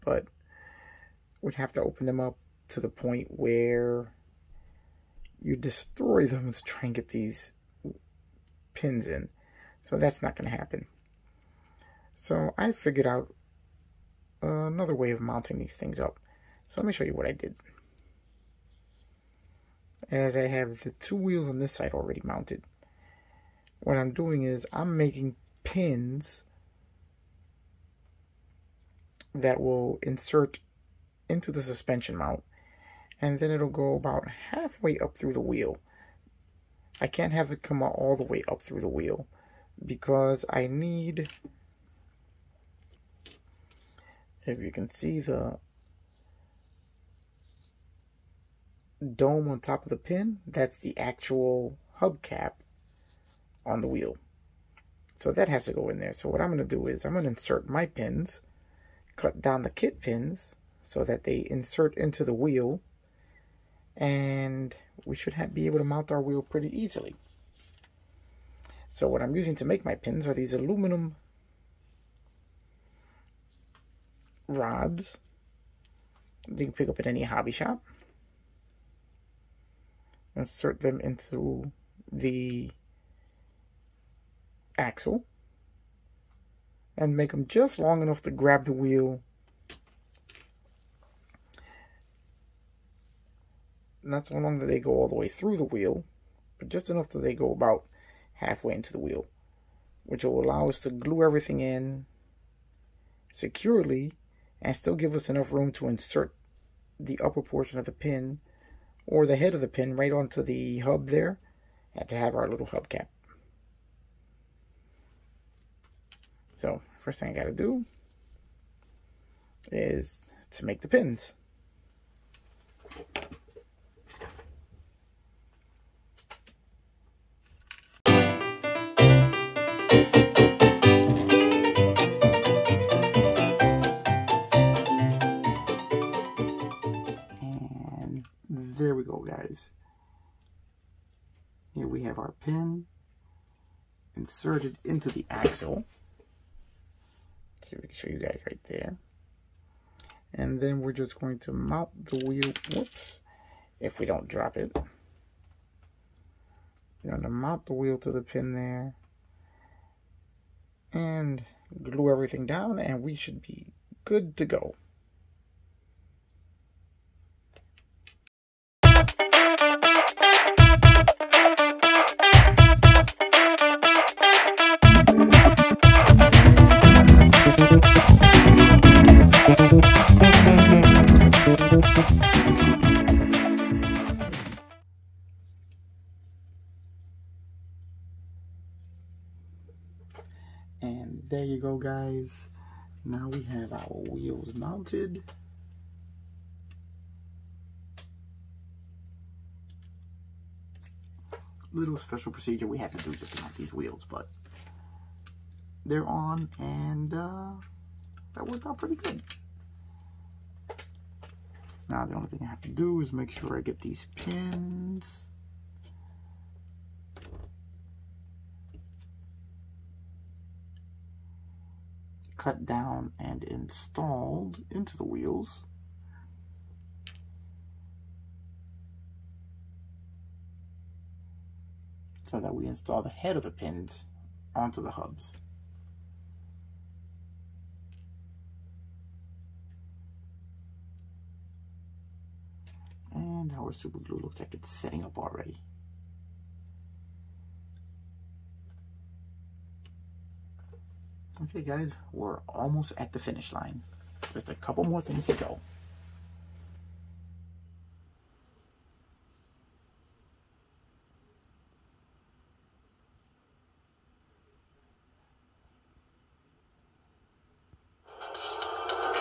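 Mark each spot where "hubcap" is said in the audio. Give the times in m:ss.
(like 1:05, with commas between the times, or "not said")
0:52, 1:52.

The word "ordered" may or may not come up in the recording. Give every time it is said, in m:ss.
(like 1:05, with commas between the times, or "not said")
not said.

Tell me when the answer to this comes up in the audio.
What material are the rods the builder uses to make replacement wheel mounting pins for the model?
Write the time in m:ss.
1:10.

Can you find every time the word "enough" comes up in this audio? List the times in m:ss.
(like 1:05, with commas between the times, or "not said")
1:28, 1:36, 1:45.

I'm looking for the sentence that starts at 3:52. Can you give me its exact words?
so that we install the head of the pins onto the hubs.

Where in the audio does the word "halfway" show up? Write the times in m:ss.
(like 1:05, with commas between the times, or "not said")
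0:34, 1:38.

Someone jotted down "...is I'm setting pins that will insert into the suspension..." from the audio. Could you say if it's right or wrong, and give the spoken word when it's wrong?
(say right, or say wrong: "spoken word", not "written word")
wrong: "making", not "setting".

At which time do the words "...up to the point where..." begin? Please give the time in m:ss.
0:02.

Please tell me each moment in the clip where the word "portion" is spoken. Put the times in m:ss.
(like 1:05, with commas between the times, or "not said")
1:47.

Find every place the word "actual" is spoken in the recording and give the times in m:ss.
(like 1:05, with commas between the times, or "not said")
0:50.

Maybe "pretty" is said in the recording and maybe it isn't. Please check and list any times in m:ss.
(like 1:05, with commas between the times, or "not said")
1:06, 3:28.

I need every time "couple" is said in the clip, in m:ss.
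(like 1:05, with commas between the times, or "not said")
4:14.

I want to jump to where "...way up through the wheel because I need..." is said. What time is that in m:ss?
0:38.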